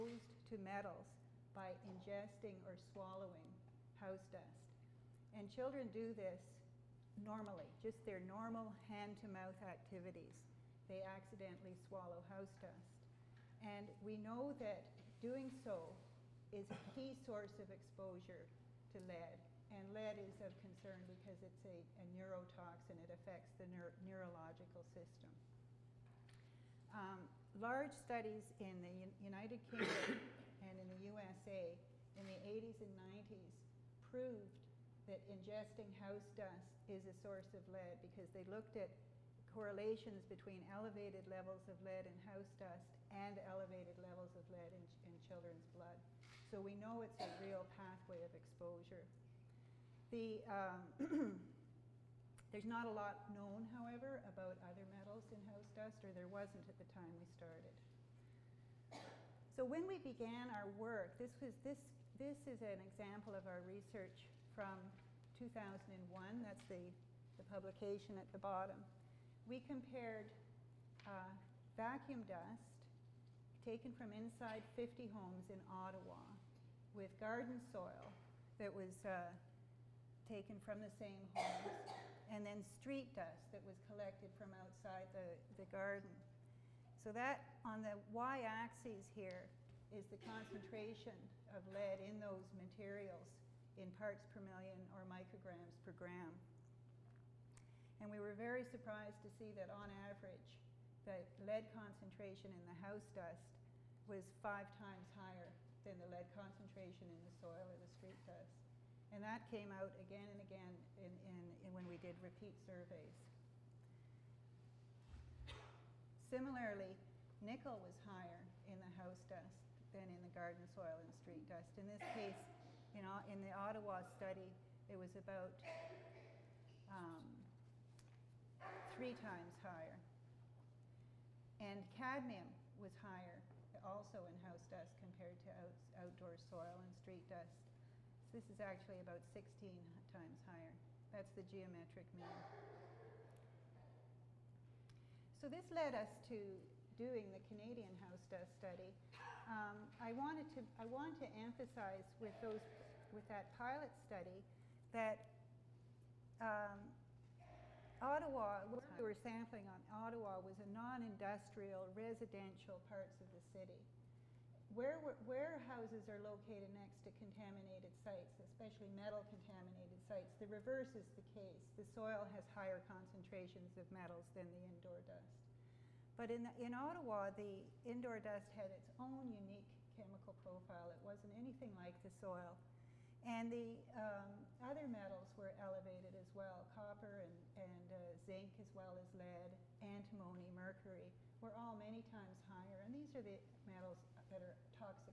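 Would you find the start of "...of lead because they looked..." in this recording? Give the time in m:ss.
0:37.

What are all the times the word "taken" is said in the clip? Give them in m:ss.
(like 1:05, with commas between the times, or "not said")
1:13, 1:20.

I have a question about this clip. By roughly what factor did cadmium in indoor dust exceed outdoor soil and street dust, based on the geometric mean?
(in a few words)
16 times.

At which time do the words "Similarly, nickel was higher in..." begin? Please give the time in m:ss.
1:56.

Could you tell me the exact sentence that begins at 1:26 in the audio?
So that on the y-axis here is the concentration of lead in those materials in parts per million or micrograms per gram.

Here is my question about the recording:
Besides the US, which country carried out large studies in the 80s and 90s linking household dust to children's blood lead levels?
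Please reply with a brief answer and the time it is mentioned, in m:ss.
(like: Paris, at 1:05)
United Kingdom, at 0:29.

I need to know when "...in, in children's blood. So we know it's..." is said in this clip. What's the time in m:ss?
0:44.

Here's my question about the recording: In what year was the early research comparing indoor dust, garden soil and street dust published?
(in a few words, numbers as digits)
2001.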